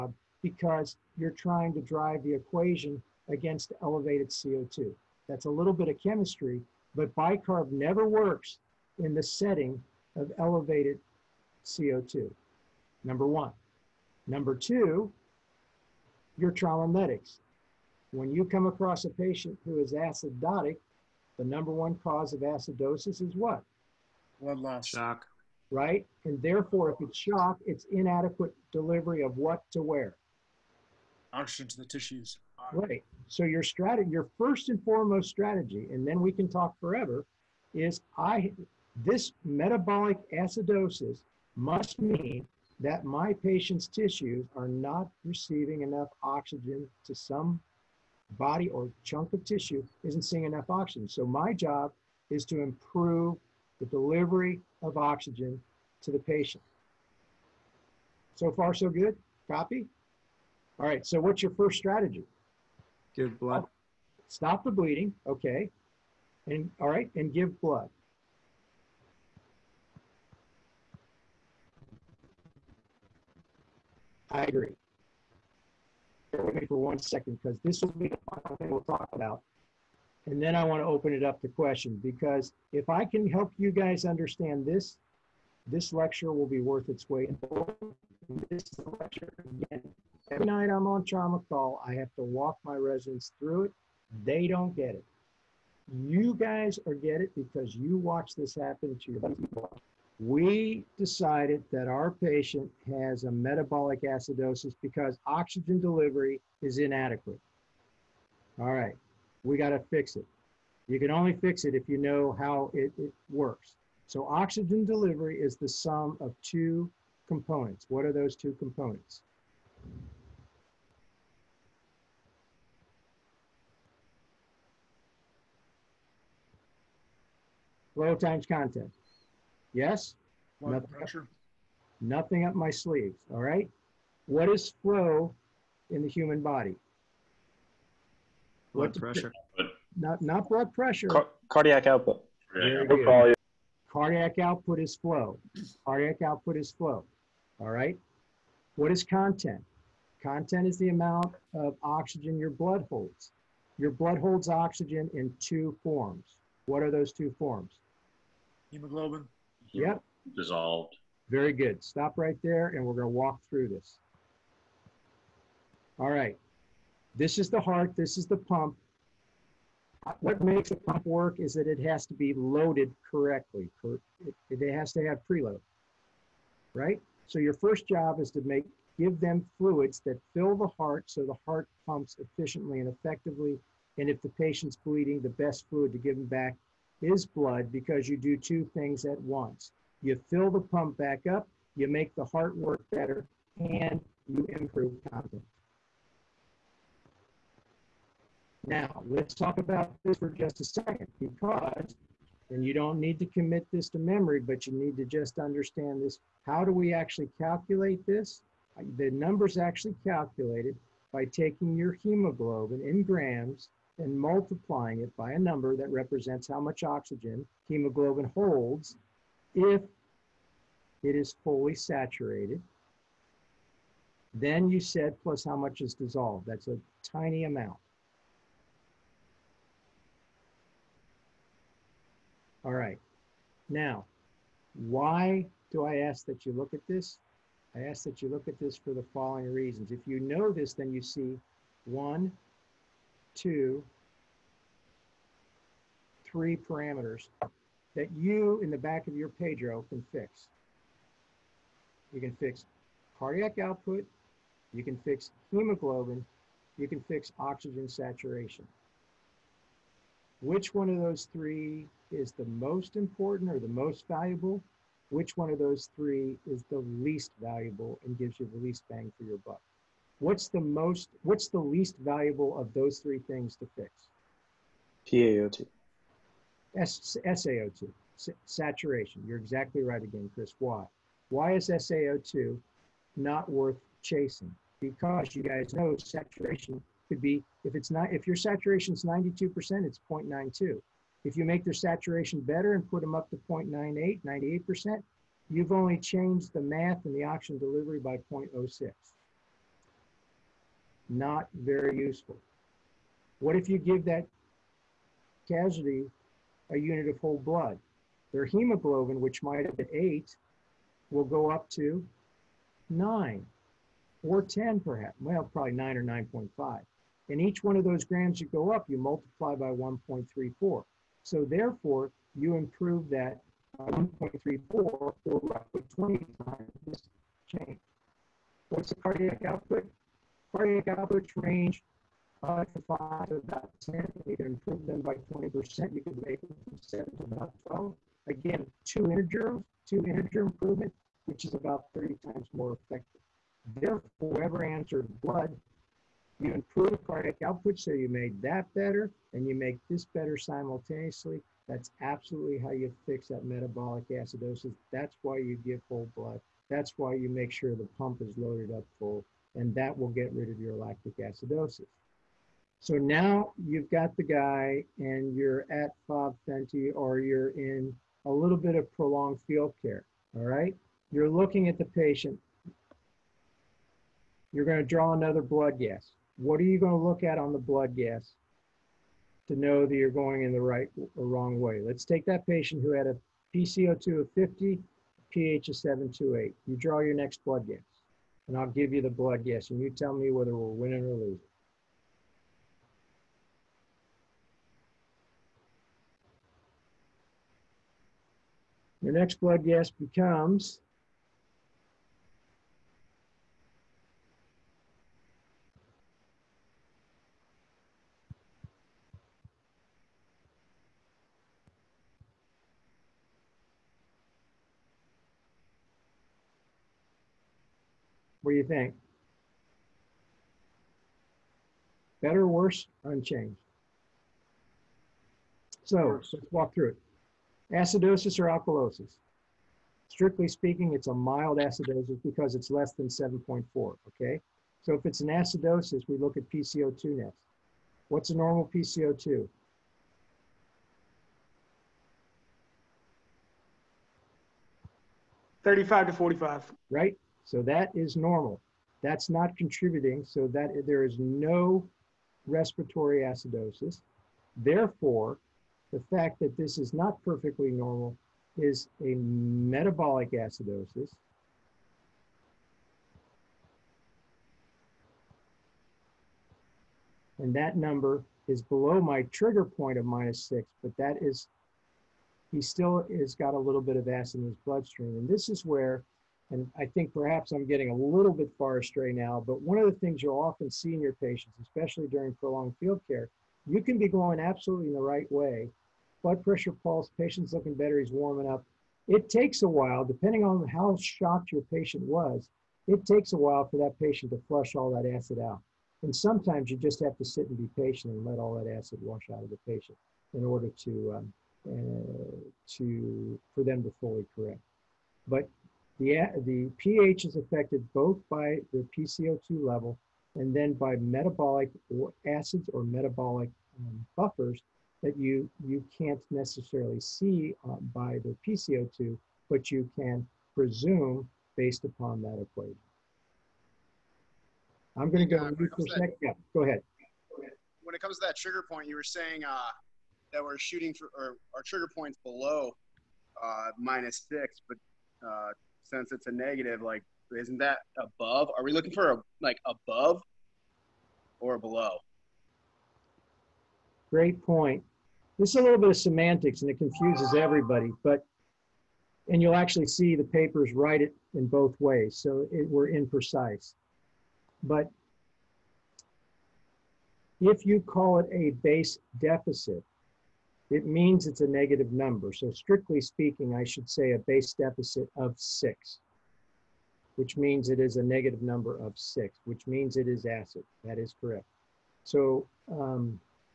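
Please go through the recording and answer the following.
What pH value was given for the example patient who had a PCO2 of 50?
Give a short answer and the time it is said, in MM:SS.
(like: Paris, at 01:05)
7.28, at 06:25.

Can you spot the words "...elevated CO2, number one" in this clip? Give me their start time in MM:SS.
00:10.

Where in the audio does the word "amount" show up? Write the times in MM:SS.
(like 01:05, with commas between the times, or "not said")
02:30, 03:47.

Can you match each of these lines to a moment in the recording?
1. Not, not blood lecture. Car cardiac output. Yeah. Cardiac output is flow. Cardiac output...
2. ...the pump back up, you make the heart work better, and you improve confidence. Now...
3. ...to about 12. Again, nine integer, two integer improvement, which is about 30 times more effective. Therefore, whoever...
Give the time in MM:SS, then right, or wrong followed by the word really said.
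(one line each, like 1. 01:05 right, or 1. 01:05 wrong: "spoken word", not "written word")
1. 02:19 wrong: "pressure", not "lecture"
2. 03:10 right
3. 05:37 wrong: "two", not "nine".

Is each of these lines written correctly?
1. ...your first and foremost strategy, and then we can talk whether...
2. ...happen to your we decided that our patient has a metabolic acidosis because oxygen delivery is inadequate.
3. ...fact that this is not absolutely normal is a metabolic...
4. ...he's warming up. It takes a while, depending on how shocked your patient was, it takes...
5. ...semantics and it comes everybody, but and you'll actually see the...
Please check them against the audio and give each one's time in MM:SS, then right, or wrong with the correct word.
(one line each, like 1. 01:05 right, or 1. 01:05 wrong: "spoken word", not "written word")
1. 00:34 wrong: "forever", not "whether"
2. 01:38 right
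3. 07:36 wrong: "perfectly", not "absolutely"
4. 08:07 right
5. 09:05 wrong: "confuses", not "comes".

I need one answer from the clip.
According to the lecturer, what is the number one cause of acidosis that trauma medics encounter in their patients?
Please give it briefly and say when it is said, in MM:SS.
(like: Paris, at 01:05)
Blood loss, at 00:24.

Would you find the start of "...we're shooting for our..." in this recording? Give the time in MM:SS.
08:50.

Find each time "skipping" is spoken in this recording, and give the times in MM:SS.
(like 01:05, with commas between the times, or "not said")
not said.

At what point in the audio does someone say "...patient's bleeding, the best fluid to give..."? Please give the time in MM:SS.
03:04.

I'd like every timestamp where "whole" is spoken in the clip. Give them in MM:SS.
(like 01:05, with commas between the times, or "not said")
05:07, 05:55.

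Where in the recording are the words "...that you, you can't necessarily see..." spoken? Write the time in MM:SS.
08:35.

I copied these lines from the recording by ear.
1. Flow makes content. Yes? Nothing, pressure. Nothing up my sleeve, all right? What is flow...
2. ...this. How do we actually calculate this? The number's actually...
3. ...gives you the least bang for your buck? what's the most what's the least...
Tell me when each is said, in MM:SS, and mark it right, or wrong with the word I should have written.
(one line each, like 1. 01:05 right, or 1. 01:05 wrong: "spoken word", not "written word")
1. 02:07 wrong: "times", not "makes"
2. 03:26 right
3. 04:28 right.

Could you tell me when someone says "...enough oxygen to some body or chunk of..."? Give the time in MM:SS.
00:45.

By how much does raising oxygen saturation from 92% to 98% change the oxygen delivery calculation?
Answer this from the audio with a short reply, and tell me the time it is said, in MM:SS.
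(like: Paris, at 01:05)
0.06, at 04:58.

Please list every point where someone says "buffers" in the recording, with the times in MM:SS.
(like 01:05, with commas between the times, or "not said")
08:34.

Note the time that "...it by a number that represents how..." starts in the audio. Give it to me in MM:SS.
03:35.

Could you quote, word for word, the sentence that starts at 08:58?
Are we looking for a like above or below?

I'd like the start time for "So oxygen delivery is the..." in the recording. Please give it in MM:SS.
01:54.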